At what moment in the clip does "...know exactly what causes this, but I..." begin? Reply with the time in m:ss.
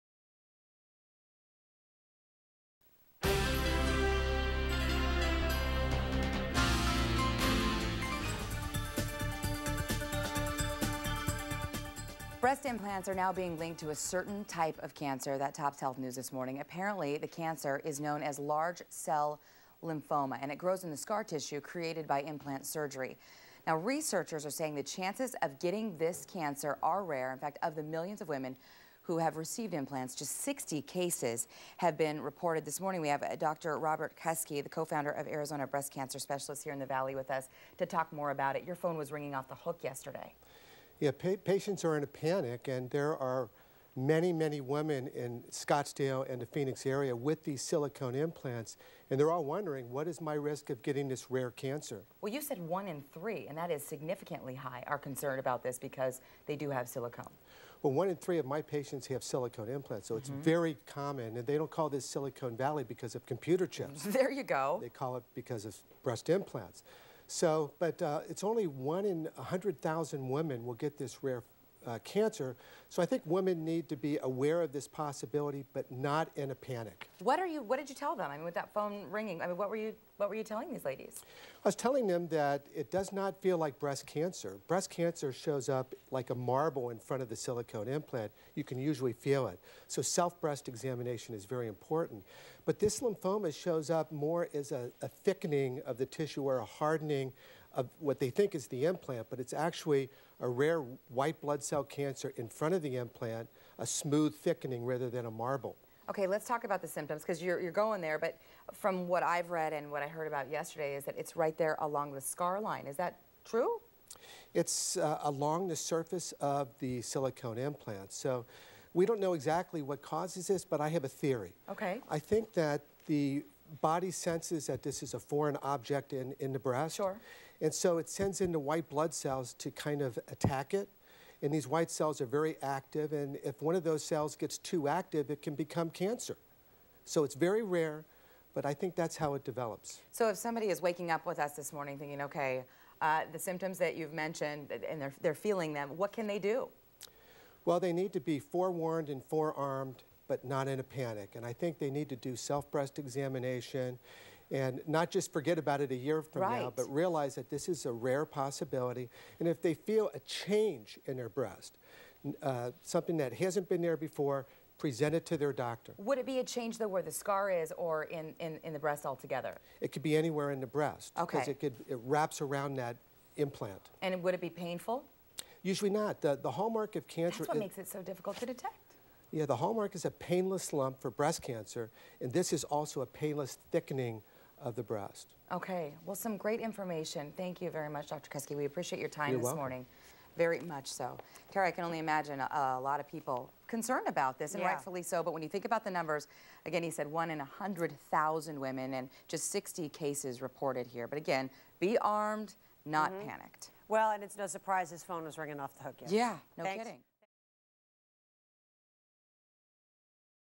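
1:59.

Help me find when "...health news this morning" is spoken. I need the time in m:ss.
0:15.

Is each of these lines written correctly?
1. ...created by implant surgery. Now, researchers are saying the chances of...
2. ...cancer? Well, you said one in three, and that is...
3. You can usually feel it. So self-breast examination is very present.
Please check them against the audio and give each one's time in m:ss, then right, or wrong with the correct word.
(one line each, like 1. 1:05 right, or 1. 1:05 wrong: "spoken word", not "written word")
1. 0:21 right
2. 0:51 right
3. 1:28 wrong: "important", not "present".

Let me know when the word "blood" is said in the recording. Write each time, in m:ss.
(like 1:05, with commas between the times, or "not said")
1:41, 2:08.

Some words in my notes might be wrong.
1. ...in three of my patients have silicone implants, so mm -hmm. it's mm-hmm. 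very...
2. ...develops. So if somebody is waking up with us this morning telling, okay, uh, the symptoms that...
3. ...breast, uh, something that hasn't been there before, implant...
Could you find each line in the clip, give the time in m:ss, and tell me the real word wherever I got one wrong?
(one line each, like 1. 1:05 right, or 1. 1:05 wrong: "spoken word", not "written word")
1. 0:58 right
2. 2:19 wrong: "thinking", not "telling"
3. 2:41 wrong: "present", not "implant".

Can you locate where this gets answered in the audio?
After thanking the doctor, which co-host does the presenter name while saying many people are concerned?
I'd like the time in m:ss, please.
3:11.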